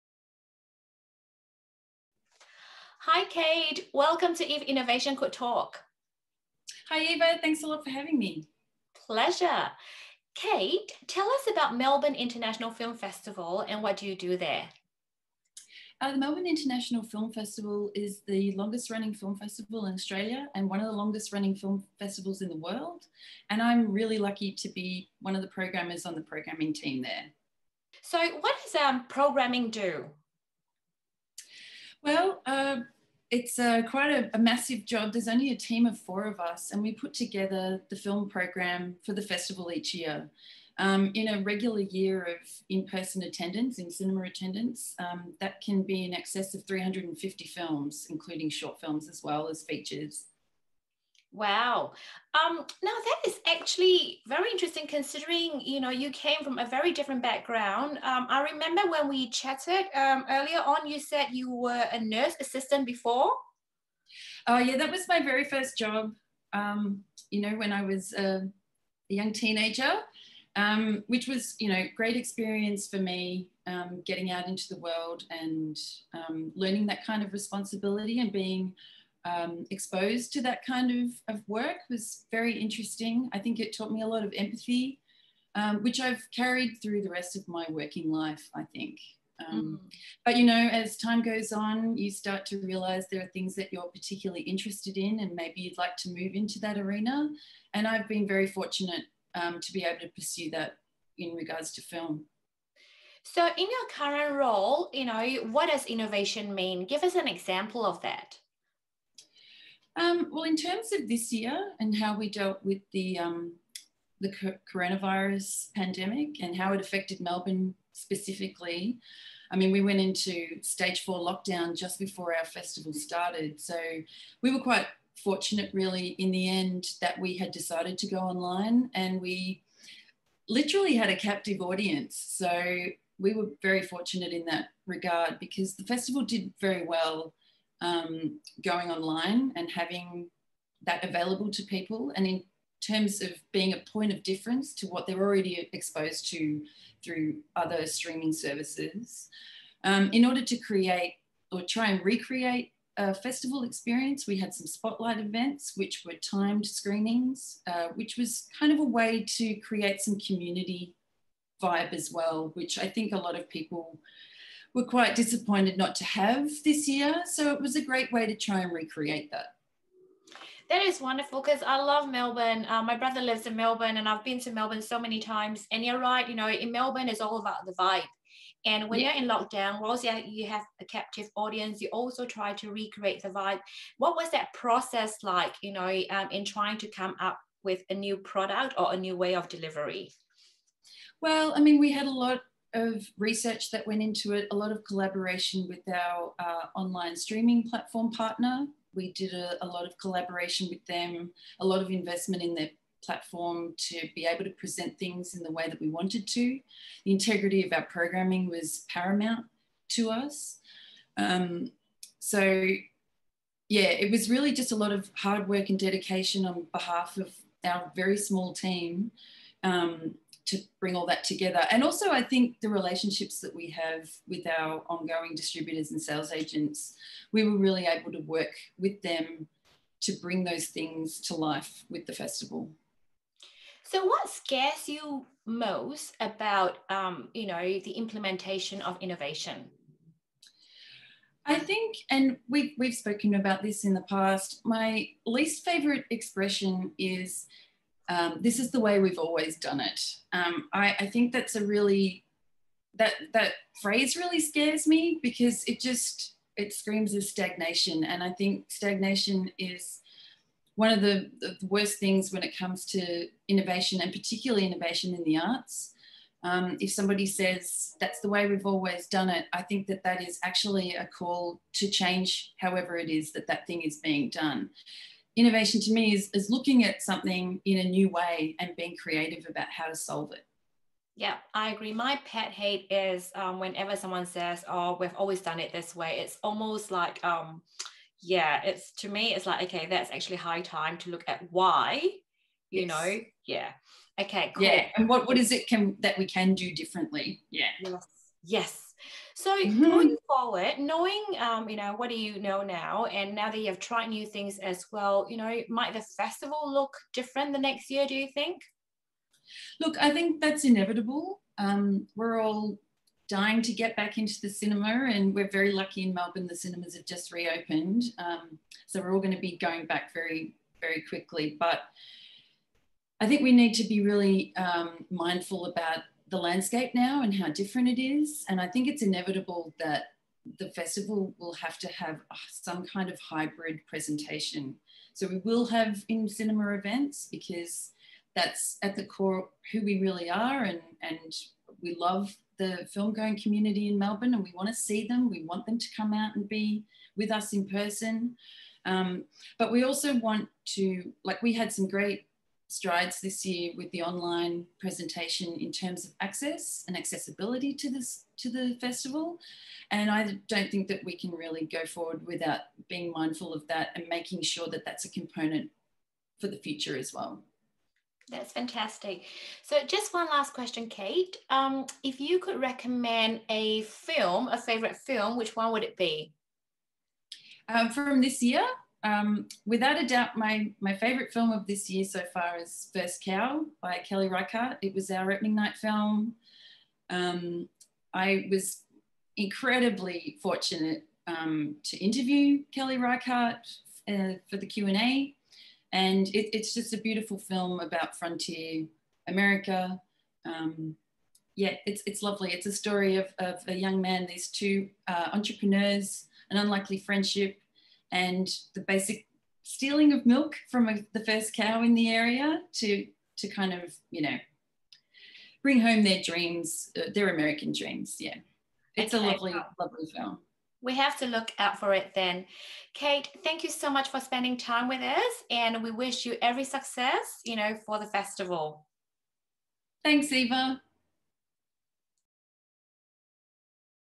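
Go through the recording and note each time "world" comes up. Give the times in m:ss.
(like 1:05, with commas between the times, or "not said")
0:22, 1:14.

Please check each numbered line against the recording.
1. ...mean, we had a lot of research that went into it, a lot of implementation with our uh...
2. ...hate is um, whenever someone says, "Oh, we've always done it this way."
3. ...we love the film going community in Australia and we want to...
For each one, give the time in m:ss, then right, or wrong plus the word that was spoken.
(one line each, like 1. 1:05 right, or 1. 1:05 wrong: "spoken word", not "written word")
1. 3:11 wrong: "collaboration", not "implementation"
2. 4:42 right
3. 5:41 wrong: "Melbourne", not "Australia".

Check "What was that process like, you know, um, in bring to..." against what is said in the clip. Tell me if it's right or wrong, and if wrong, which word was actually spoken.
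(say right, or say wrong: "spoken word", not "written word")
wrong: "trying", not "bring".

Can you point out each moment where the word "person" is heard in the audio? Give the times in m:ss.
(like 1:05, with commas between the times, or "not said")
0:42, 5:47.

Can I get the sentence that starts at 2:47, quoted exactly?
So it was a great way to try and recreate that.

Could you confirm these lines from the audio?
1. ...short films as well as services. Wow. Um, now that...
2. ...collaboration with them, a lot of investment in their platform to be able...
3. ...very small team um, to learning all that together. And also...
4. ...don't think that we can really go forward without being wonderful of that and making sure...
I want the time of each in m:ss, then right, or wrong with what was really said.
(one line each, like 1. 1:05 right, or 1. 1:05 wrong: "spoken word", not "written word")
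1. 0:48 wrong: "features", not "services"
2. 3:19 right
3. 3:37 wrong: "bring", not "learning"
4. 6:00 wrong: "mindful", not "wonderful".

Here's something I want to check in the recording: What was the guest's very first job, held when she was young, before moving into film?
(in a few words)
Nurse assistant.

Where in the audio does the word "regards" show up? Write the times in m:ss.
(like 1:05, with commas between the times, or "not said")
1:41, 2:14.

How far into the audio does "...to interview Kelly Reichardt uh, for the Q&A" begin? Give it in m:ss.
6:31.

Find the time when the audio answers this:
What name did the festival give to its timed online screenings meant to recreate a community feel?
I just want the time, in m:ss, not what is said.
2:34.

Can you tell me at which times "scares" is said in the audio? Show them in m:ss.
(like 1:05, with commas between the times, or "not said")
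3:54, 4:14.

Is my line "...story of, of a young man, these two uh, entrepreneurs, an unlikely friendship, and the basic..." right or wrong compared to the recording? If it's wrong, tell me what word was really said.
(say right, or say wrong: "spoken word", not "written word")
right.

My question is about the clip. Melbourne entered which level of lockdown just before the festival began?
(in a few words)
Stage four.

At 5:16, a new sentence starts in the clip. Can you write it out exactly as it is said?
The cinemas have just reopened, um, so we're all going to be going back very, very quickly.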